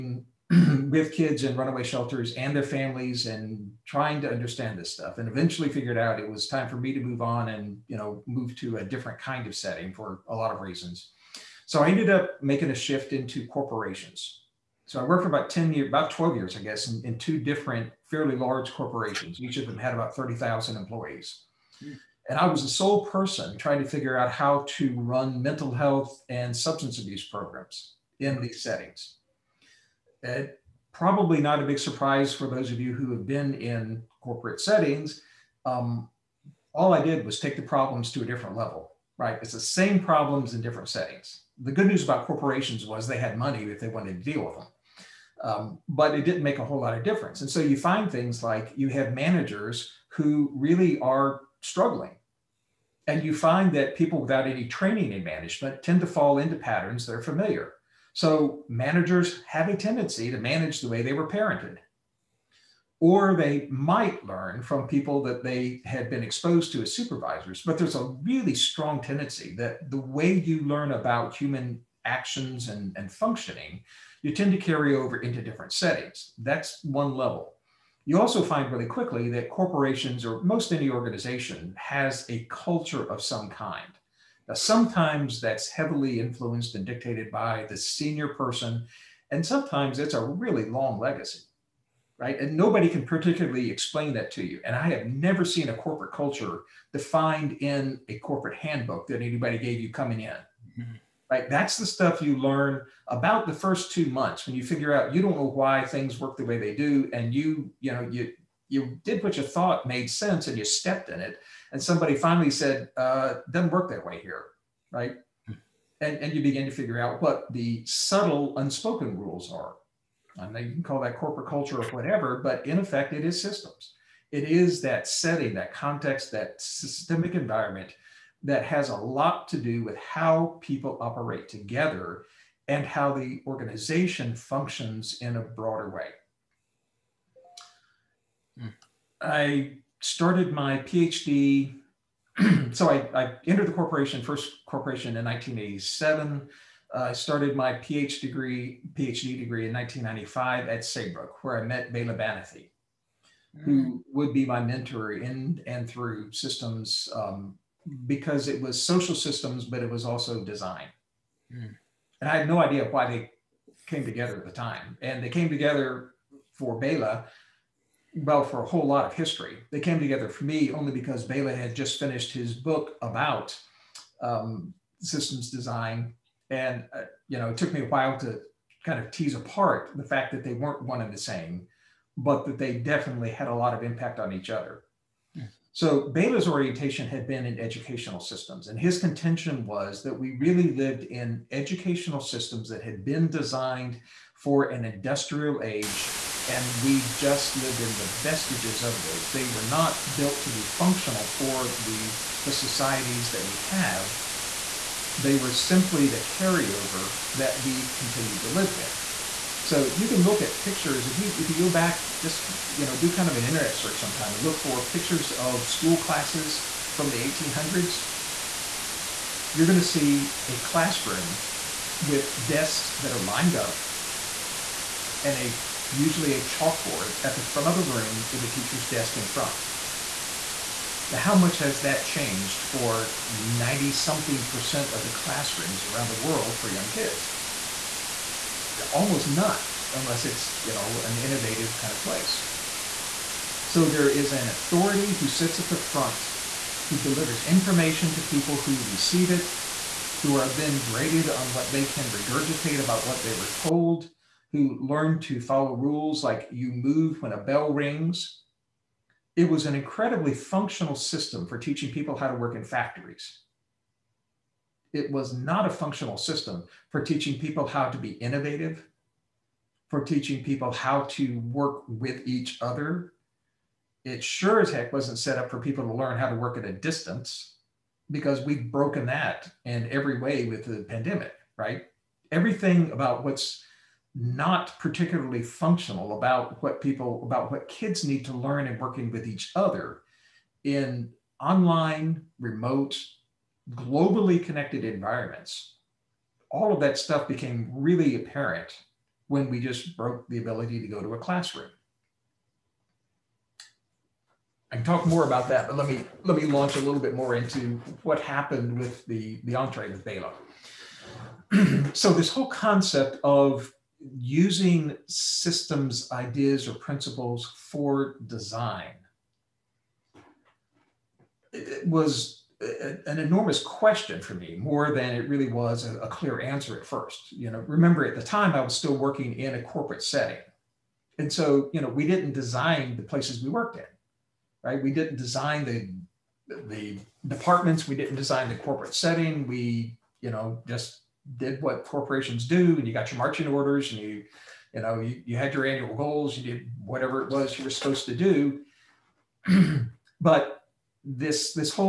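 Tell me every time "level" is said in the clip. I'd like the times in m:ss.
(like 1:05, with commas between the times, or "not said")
0:38, 1:17.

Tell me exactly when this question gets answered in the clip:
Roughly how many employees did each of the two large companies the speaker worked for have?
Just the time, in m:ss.
0:20.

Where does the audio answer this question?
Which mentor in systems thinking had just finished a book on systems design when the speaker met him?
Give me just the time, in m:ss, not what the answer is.
2:31.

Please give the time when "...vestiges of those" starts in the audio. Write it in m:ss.
3:18.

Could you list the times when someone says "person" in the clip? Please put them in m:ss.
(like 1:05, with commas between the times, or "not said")
0:23, 1:28.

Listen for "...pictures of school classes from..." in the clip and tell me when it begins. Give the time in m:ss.
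3:34.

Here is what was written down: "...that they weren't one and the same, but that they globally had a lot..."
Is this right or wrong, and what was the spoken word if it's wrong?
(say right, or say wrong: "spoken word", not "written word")
wrong: "definitely", not "globally".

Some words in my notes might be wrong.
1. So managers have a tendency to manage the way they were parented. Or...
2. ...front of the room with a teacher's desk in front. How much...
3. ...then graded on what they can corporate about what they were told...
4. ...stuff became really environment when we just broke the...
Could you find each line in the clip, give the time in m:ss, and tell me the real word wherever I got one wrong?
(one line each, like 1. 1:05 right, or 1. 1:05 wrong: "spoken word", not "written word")
1. 0:58 right
2. 3:47 right
3. 4:10 wrong: "regurgitate", not "corporate"
4. 4:56 wrong: "apparent", not "environment".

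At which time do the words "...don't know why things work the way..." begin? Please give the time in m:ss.
1:45.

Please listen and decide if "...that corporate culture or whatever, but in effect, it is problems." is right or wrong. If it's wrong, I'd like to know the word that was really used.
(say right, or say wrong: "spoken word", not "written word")
wrong: "systems", not "problems".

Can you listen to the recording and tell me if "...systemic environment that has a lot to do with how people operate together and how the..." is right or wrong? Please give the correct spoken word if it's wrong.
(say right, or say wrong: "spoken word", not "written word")
right.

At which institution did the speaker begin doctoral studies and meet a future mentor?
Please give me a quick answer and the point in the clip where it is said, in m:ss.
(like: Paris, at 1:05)
Saybrook, at 2:30.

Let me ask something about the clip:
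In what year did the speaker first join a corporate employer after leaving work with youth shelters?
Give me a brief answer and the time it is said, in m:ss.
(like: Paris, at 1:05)
1987, at 2:25.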